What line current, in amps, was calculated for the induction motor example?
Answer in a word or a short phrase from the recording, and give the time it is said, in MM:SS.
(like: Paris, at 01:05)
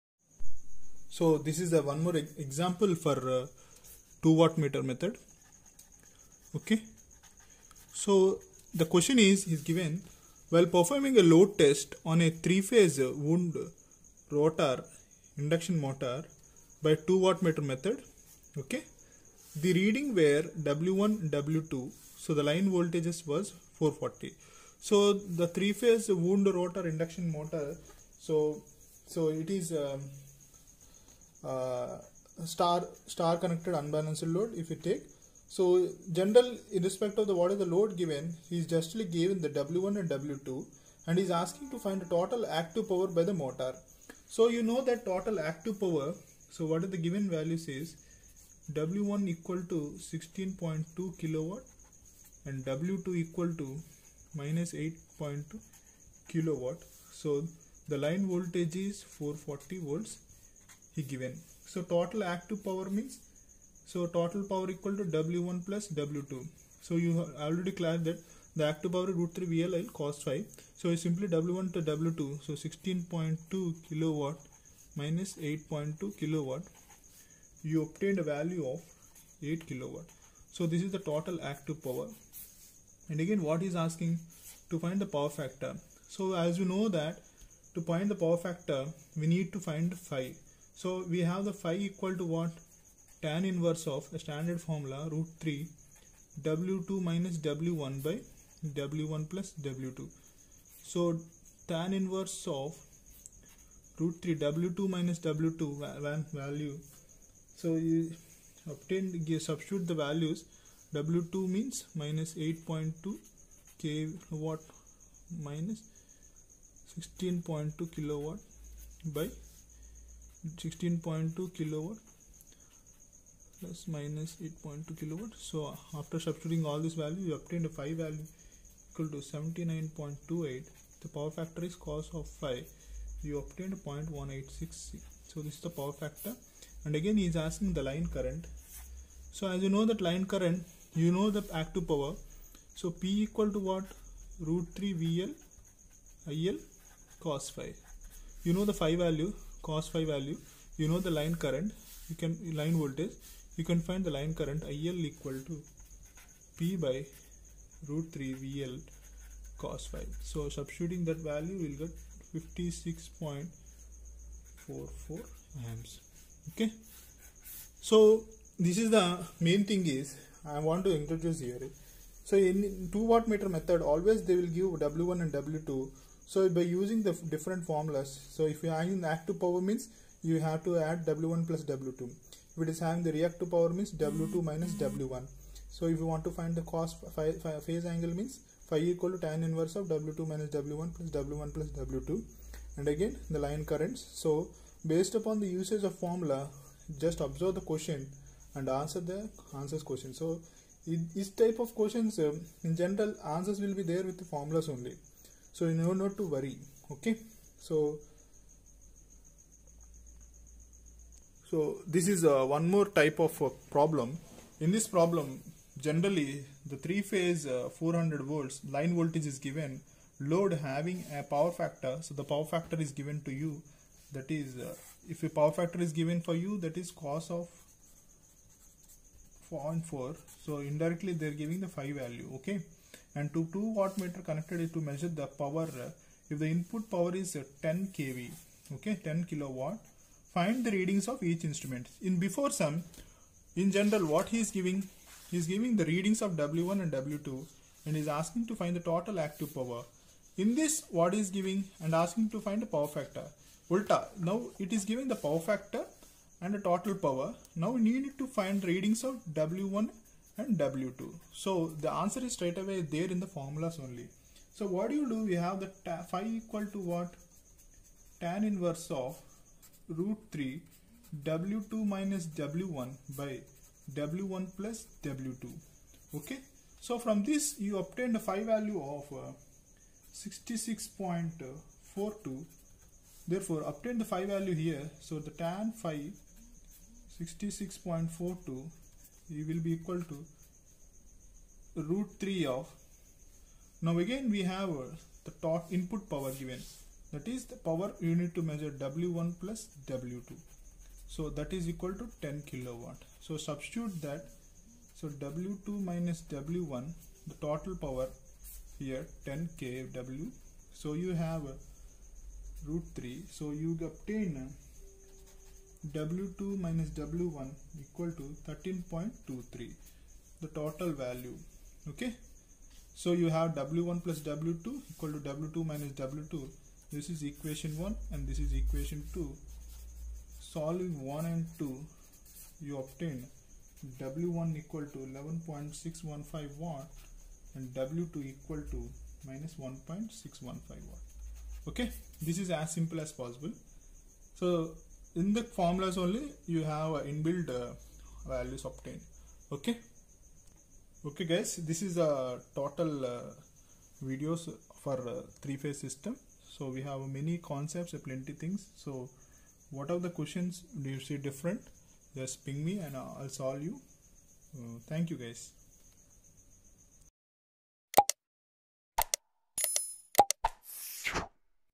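56.44 amps, at 02:42.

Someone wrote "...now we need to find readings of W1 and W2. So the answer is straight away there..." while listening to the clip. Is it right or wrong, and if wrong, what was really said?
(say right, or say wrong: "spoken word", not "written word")
right.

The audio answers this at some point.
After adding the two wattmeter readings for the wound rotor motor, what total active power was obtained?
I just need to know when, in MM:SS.
01:19.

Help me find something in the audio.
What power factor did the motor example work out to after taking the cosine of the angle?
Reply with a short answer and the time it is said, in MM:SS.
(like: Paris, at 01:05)
0.186, at 02:13.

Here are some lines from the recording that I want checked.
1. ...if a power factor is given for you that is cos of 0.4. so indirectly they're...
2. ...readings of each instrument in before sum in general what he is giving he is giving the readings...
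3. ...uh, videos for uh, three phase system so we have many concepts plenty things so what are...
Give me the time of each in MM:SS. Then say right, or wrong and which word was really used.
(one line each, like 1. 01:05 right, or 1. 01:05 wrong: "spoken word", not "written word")
1. 03:45 right
2. 04:00 right
3. 05:53 right.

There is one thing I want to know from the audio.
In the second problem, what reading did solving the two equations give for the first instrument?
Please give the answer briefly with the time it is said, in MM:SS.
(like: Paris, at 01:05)
11.615, at 05:34.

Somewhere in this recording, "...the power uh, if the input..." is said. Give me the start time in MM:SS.
03:55.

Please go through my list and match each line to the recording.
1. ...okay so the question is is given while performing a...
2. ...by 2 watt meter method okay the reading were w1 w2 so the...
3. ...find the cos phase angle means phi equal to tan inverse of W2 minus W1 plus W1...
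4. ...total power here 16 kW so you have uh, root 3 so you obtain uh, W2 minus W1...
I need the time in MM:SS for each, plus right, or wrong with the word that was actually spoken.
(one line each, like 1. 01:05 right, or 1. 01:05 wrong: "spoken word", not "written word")
1. 00:06 right
2. 00:16 right
3. 03:06 right
4. 05:07 wrong: "10", not "16".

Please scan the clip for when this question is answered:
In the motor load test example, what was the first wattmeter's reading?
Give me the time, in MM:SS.
00:48.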